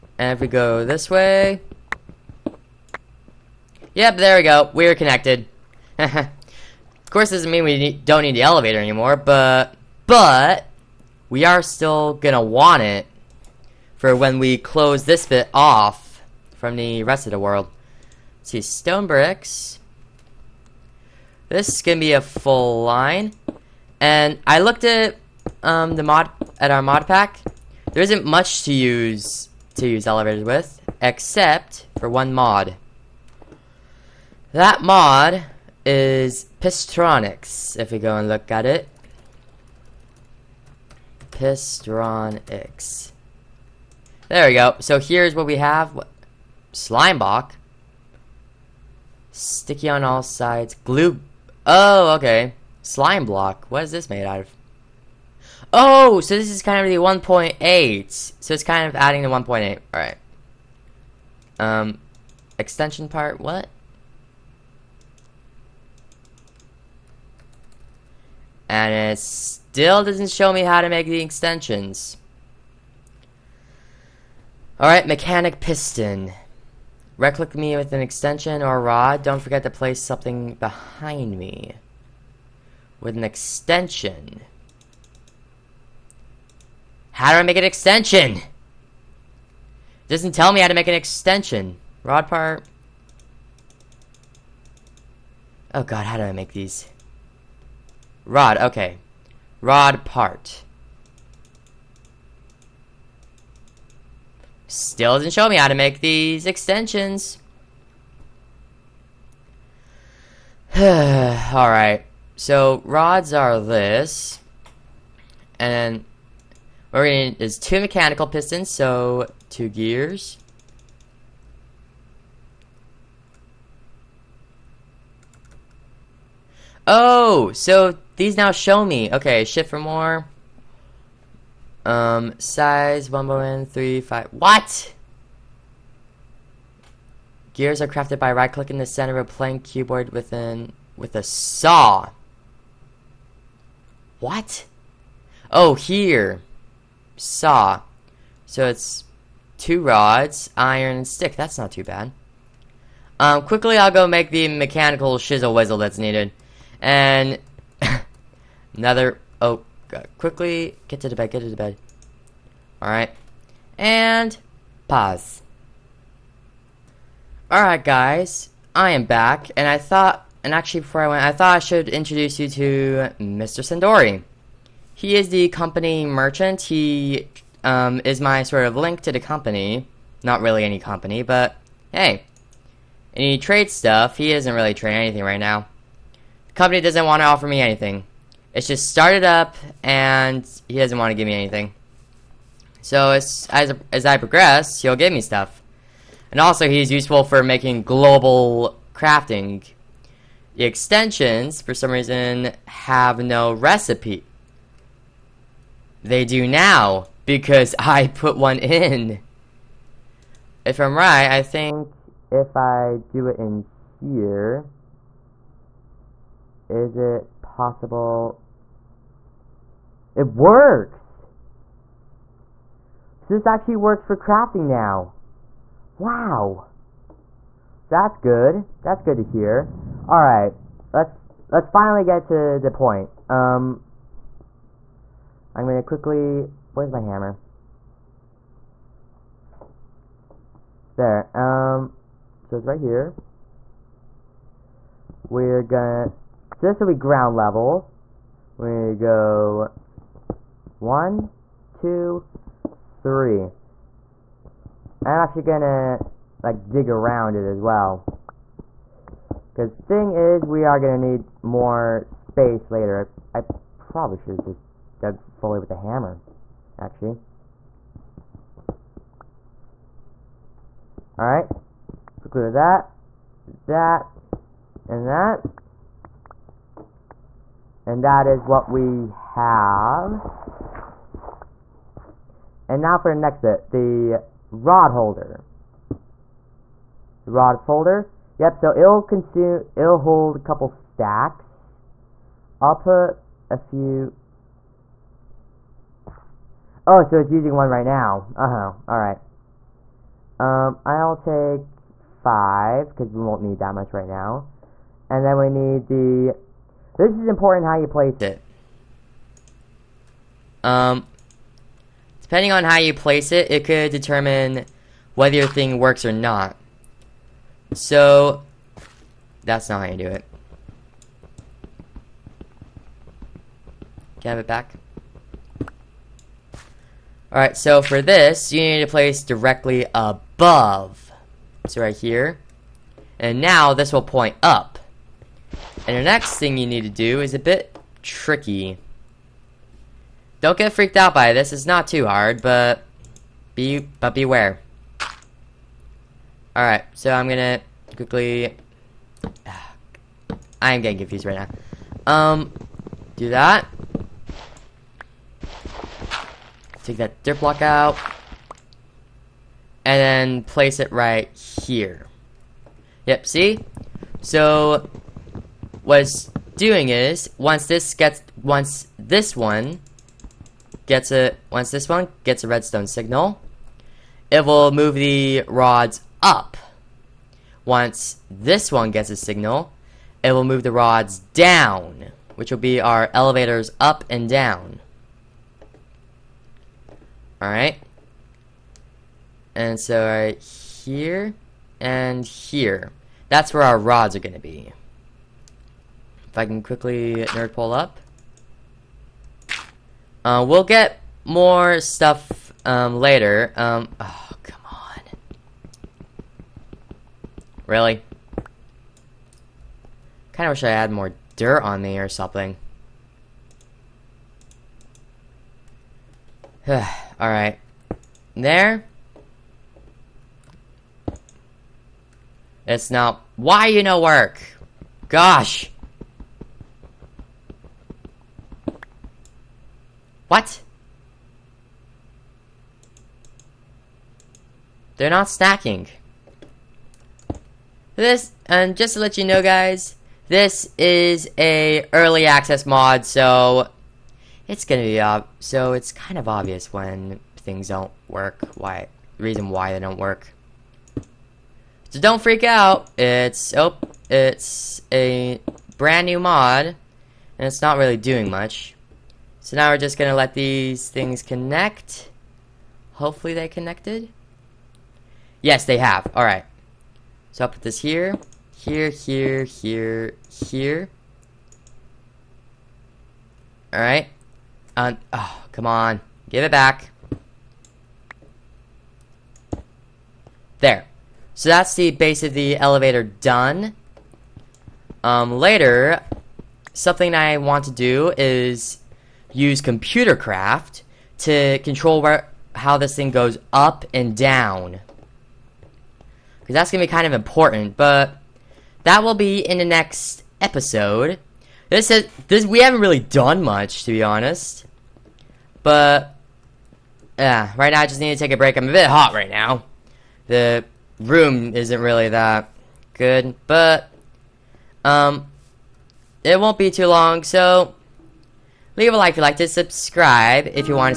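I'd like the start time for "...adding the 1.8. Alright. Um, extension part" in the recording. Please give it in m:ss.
0:58.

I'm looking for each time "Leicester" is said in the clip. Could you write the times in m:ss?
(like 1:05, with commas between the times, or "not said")
not said.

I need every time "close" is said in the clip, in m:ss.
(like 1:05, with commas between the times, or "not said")
0:14.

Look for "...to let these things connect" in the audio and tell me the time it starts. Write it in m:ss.
7:40.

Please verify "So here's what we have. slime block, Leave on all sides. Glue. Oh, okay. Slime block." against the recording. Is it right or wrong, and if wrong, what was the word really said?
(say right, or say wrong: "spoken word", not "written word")
wrong: "Sticky", not "Leave".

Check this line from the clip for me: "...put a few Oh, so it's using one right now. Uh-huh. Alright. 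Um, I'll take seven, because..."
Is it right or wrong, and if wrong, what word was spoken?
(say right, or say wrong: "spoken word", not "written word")
wrong: "five", not "seven".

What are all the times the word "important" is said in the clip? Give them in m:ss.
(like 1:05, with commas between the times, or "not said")
5:07, 8:17.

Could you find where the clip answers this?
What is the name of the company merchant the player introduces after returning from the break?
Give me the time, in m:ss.
2:53.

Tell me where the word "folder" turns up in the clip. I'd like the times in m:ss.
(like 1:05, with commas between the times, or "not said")
4:47.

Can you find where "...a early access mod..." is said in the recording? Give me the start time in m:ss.
7:21.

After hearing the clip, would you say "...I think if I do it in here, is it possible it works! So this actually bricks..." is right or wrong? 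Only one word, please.
wrong.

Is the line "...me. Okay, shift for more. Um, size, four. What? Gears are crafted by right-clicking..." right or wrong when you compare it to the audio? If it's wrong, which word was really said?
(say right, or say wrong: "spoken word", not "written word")
wrong: "five", not "four".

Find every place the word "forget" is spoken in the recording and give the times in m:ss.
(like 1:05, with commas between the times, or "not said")
1:19.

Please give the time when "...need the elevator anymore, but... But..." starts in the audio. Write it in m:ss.
0:08.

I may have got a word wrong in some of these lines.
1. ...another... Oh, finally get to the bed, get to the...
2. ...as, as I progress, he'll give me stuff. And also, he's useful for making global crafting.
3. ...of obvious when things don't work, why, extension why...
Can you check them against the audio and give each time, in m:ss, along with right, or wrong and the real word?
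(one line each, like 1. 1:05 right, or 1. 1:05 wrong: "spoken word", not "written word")
1. 2:38 wrong: "quickly", not "finally"
2. 3:13 right
3. 7:26 wrong: "reason", not "extension".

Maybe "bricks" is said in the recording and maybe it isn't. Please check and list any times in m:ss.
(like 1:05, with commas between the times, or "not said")
0:19.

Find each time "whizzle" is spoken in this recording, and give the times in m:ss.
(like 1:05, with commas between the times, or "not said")
2:35.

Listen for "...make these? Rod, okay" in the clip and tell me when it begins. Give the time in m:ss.
1:36.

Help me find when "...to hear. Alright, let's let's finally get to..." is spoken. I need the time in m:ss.
3:49.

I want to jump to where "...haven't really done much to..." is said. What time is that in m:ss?
8:22.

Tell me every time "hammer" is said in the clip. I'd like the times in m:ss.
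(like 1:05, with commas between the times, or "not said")
3:56, 4:25.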